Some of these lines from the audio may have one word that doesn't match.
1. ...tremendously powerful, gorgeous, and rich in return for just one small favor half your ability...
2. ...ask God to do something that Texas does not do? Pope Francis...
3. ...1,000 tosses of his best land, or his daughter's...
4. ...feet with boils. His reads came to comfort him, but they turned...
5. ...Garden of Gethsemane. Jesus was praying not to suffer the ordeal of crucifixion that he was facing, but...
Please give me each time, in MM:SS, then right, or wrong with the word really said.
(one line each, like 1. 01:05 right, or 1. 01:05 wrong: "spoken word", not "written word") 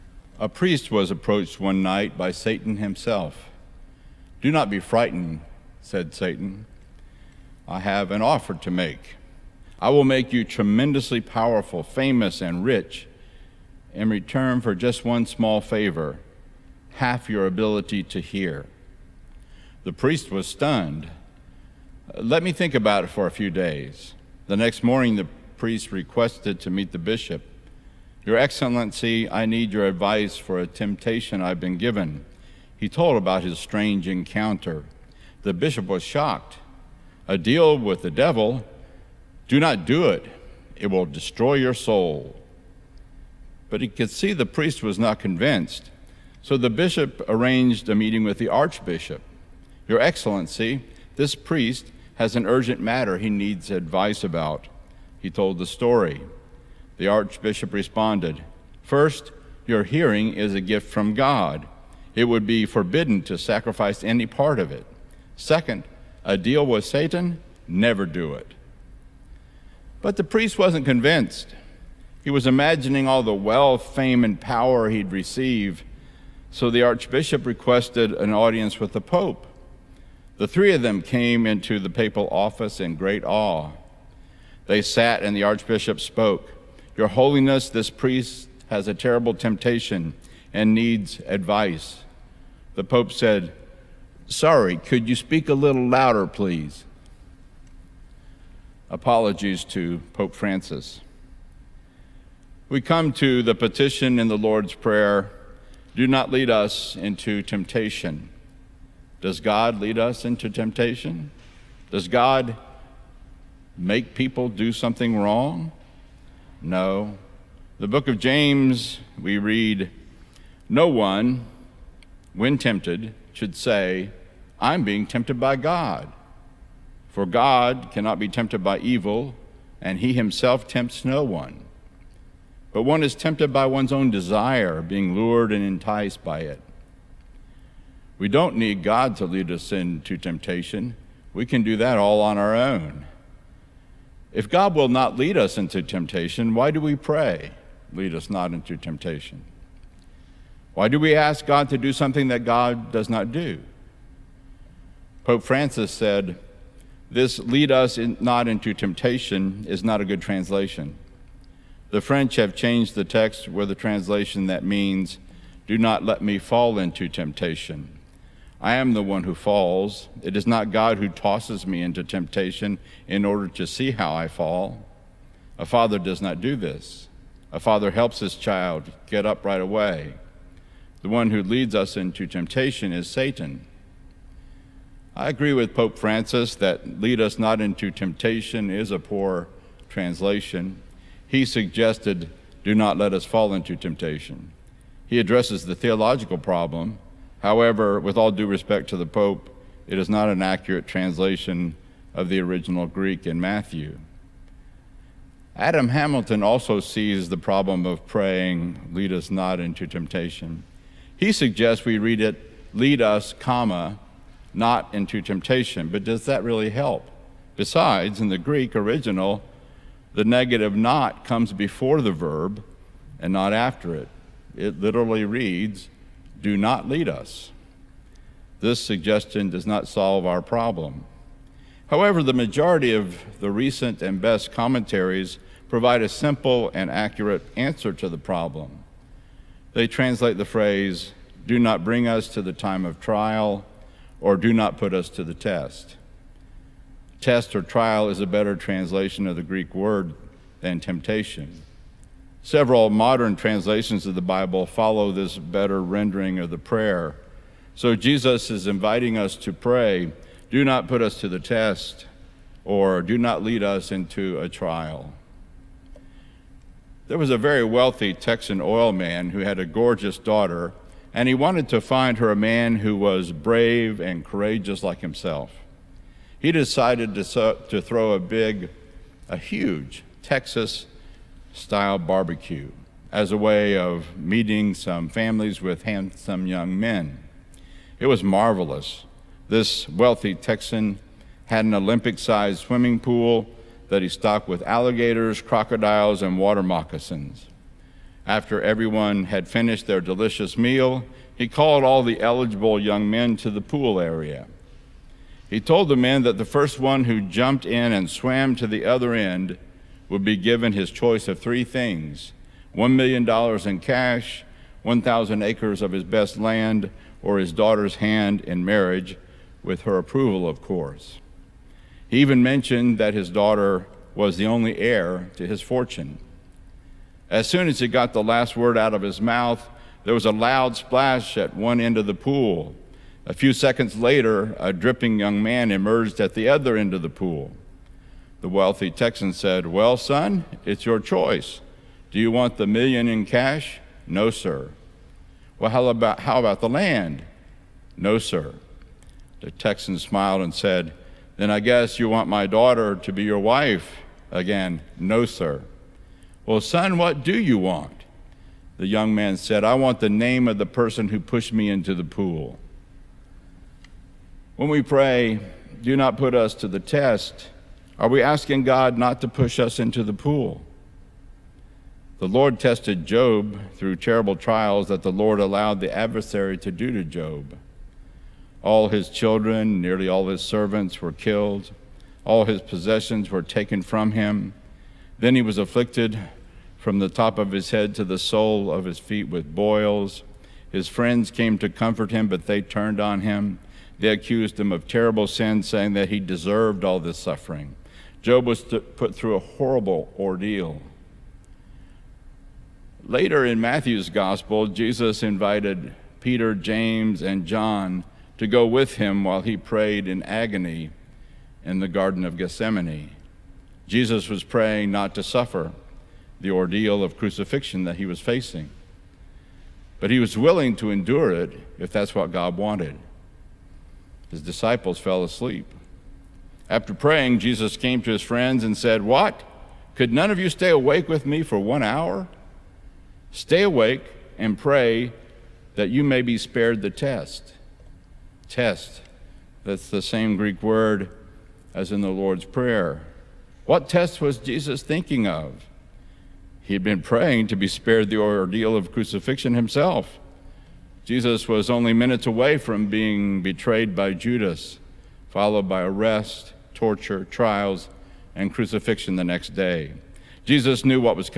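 1. 00:10 wrong: "famous", not "gorgeous"
2. 02:31 wrong: "God", not "Texas"
3. 05:14 wrong: "acres", not "tosses"
4. 06:28 wrong: "friends", not "reads"
5. 06:51 right.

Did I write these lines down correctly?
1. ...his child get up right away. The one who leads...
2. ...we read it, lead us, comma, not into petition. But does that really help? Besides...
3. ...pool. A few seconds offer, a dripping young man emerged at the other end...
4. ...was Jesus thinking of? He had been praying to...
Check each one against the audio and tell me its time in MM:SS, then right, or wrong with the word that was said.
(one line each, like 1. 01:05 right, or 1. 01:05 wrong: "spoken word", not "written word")
1. 02:58 right
2. 03:31 wrong: "temptation", not "petition"
3. 05:32 wrong: "later", not "offer"
4. 07:24 right.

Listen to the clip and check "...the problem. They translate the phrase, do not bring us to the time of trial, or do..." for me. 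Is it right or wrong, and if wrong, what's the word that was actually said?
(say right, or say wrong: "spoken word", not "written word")
right.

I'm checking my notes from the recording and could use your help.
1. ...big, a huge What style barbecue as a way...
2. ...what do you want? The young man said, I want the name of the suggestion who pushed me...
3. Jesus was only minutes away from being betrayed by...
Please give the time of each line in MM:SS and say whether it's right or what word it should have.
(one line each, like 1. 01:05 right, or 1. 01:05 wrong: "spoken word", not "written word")
1. 04:38 wrong: "Texas", not "What"
2. 05:56 wrong: "person", not "suggestion"
3. 07:31 right.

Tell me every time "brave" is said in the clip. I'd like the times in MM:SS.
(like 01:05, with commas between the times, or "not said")
04:33.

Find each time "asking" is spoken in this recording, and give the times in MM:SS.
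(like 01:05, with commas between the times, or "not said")
06:08.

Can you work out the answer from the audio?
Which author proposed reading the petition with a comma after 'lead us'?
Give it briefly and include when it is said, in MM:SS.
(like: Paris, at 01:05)
Adam Hamilton, at 03:25.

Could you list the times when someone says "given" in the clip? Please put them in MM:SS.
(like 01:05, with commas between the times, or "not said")
00:31, 05:10.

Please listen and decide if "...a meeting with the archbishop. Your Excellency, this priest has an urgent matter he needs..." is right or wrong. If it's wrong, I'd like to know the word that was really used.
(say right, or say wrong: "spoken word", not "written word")
right.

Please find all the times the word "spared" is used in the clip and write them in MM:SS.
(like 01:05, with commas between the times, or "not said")
07:16, 07:27.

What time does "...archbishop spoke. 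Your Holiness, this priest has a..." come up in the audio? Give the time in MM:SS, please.
01:25.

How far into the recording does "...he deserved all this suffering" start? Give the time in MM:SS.
06:36.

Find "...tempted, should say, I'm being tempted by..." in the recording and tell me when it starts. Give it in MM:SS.
02:02.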